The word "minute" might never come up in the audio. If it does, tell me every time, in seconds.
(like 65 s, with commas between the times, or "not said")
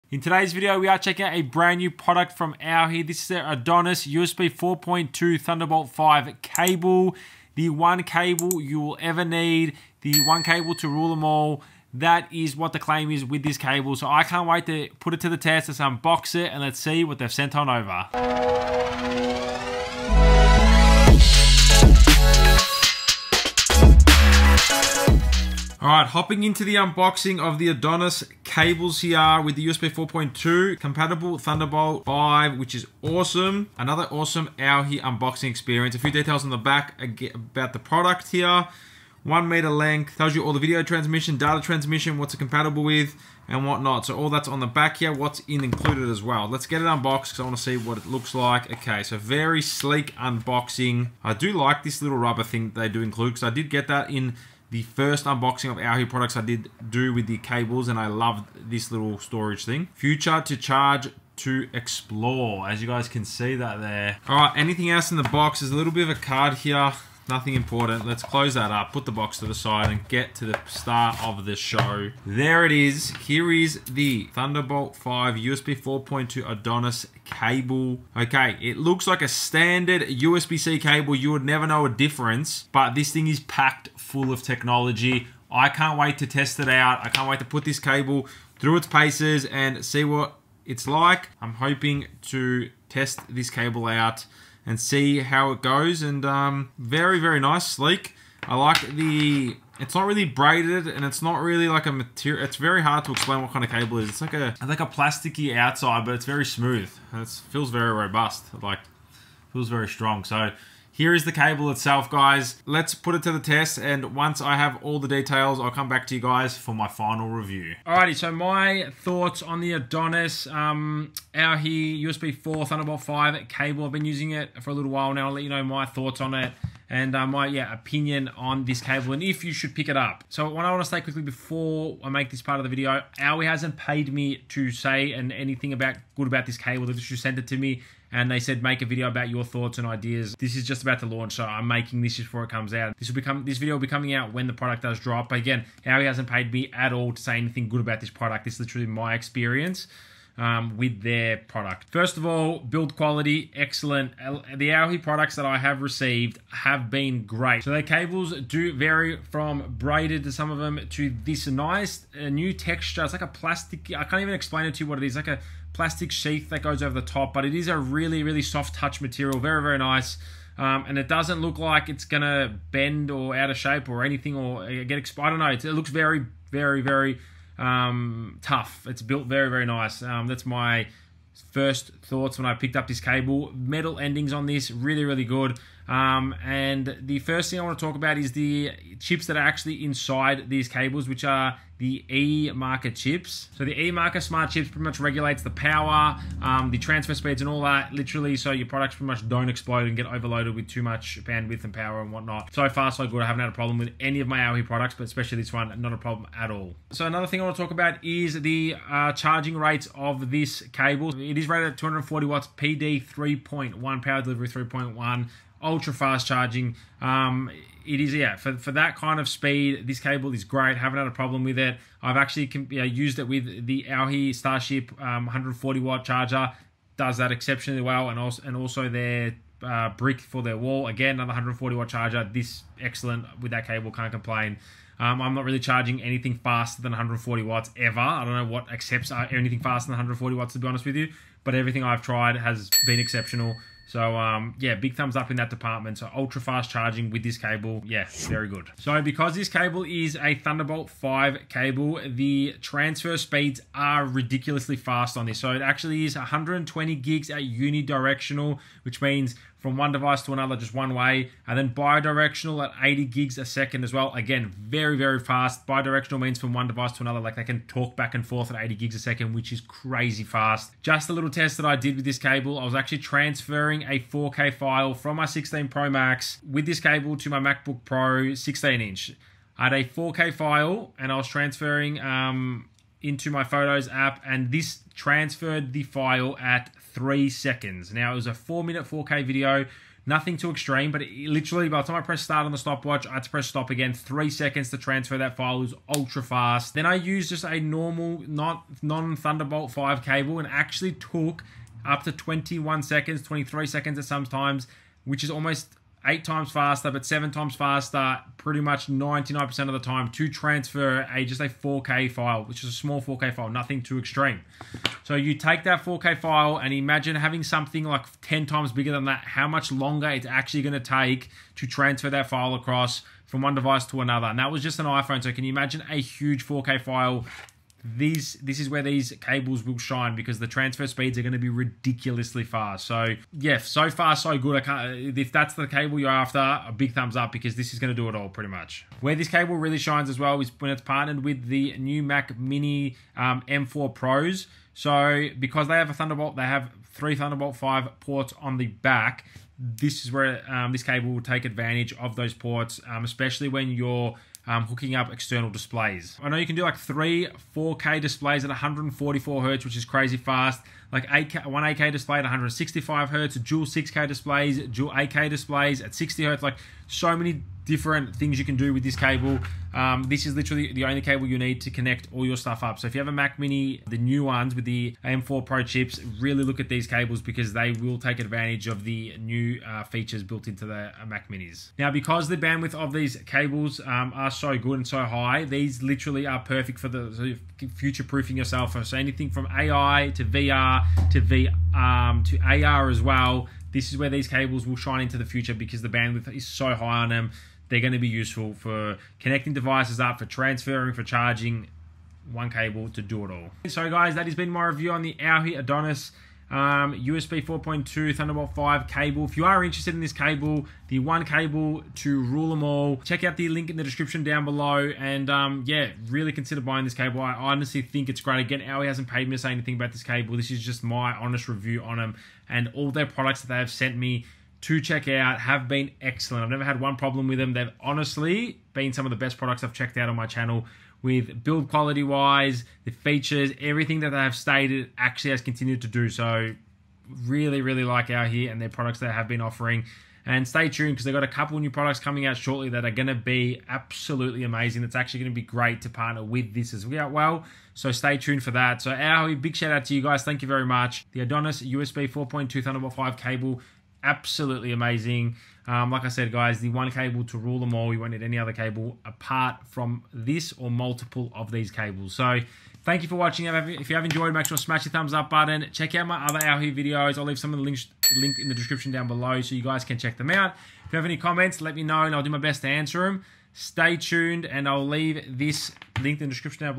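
288 s.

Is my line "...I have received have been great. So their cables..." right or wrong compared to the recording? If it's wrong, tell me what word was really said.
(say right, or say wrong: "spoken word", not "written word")
right.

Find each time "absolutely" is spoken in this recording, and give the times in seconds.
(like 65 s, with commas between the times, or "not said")
443 s, 454 s.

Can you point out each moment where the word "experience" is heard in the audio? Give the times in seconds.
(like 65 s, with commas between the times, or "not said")
35 s, 149 s.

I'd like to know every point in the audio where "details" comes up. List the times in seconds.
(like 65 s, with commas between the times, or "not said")
36 s, 115 s.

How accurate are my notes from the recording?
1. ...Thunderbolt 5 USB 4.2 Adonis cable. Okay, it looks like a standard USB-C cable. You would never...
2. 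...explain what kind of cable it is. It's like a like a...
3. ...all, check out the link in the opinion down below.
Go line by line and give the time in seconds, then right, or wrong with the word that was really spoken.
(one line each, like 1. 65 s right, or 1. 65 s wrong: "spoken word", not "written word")
1. 74 s right
2. 103 s right
3. 412 s wrong: "description", not "opinion".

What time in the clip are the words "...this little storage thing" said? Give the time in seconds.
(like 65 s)
58 s.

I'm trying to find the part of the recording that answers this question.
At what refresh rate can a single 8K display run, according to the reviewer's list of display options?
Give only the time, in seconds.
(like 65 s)
362 s.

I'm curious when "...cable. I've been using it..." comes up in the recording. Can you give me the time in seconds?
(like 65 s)
123 s.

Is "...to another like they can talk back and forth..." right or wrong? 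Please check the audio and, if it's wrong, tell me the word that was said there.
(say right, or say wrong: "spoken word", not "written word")
right.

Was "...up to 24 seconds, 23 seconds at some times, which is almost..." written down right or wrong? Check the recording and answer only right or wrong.
wrong.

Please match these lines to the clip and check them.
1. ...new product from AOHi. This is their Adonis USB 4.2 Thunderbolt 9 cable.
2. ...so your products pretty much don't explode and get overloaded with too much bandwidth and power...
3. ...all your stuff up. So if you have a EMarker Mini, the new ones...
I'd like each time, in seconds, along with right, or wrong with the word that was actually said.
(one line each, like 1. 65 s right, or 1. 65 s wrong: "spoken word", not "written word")
1. 1 s wrong: "5", not "9"
2. 198 s right
3. 372 s wrong: "Mac", not "EMarker".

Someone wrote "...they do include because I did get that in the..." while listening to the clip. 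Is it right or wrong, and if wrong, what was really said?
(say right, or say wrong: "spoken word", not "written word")
right.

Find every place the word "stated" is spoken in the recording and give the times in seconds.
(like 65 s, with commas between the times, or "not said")
434 s.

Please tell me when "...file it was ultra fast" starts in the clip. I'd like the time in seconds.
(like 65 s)
295 s.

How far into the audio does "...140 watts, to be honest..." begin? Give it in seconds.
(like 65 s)
239 s.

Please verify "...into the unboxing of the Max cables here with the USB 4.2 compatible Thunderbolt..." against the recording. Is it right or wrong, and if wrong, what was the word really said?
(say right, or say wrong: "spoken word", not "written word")
wrong: "Adonis", not "Max".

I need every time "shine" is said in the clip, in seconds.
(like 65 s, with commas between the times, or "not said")
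329 s, 339 s, 394 s.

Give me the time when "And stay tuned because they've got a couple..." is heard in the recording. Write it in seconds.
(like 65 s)
440 s.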